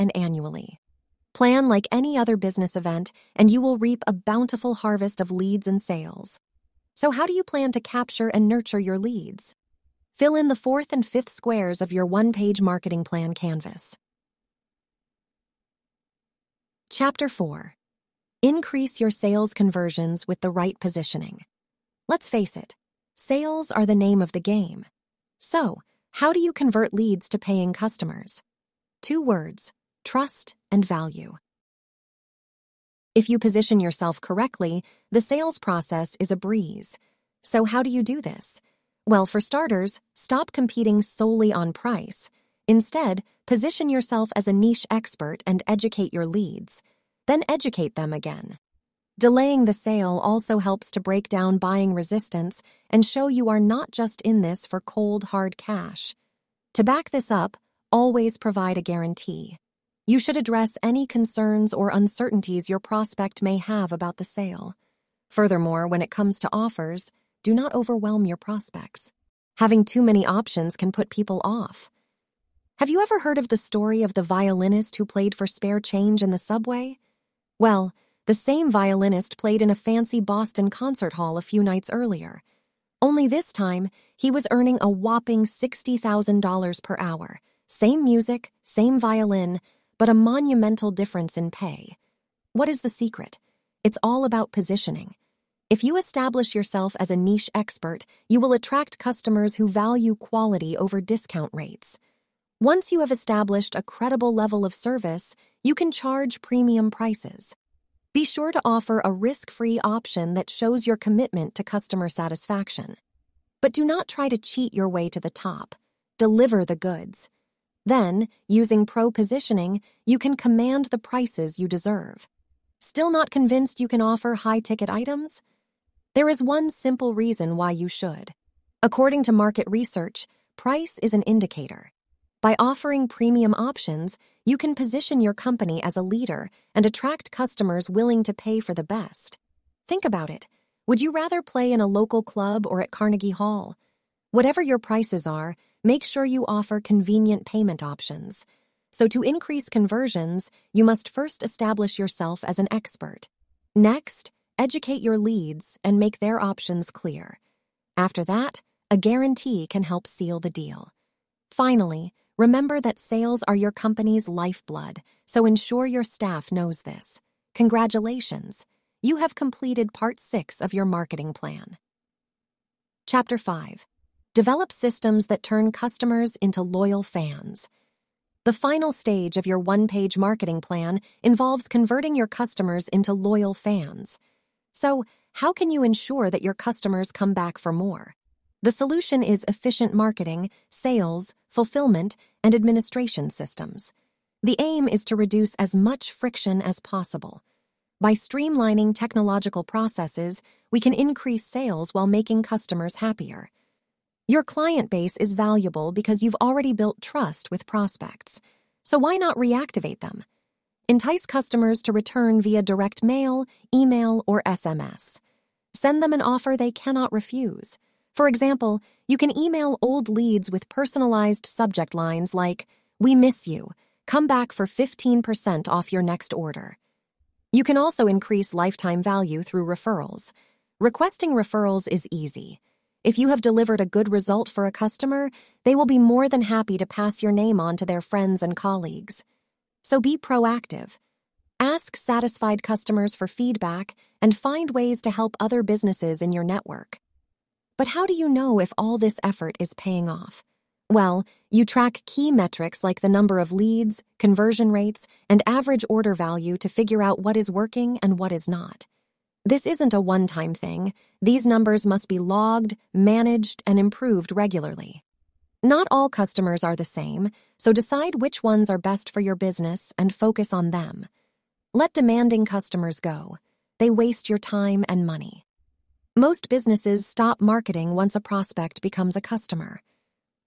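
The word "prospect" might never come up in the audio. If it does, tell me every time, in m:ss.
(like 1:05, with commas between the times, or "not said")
1:02, 1:08, 3:27, 4:38.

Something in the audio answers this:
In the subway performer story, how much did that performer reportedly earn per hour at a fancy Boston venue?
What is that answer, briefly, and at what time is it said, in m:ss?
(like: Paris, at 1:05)
$60,000, at 1:25.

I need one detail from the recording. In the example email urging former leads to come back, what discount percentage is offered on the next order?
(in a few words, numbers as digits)
15%.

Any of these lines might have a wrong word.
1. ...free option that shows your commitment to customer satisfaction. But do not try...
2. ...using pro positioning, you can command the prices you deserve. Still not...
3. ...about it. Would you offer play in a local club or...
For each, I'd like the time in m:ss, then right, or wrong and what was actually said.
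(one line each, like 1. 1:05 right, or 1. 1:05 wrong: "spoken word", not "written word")
1. 1:49 right
2. 1:58 right
3. 2:20 wrong: "rather", not "offer".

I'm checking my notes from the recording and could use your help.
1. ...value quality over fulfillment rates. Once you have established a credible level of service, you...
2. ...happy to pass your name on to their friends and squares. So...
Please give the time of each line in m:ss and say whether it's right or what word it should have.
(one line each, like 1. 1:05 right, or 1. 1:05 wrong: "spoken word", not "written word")
1. 1:39 wrong: "discount", not "fulfillment"
2. 3:56 wrong: "colleagues", not "squares".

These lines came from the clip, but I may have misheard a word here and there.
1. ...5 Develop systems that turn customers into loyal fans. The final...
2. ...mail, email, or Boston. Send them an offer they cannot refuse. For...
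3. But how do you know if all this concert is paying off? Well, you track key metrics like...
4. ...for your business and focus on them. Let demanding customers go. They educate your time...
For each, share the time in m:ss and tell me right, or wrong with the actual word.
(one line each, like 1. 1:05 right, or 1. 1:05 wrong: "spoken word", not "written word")
1. 2:53 right
2. 3:33 wrong: "SMS", not "Boston"
3. 4:07 wrong: "effort", not "concert"
4. 4:29 wrong: "waste", not "educate".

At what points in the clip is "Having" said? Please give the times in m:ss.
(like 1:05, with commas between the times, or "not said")
1:09.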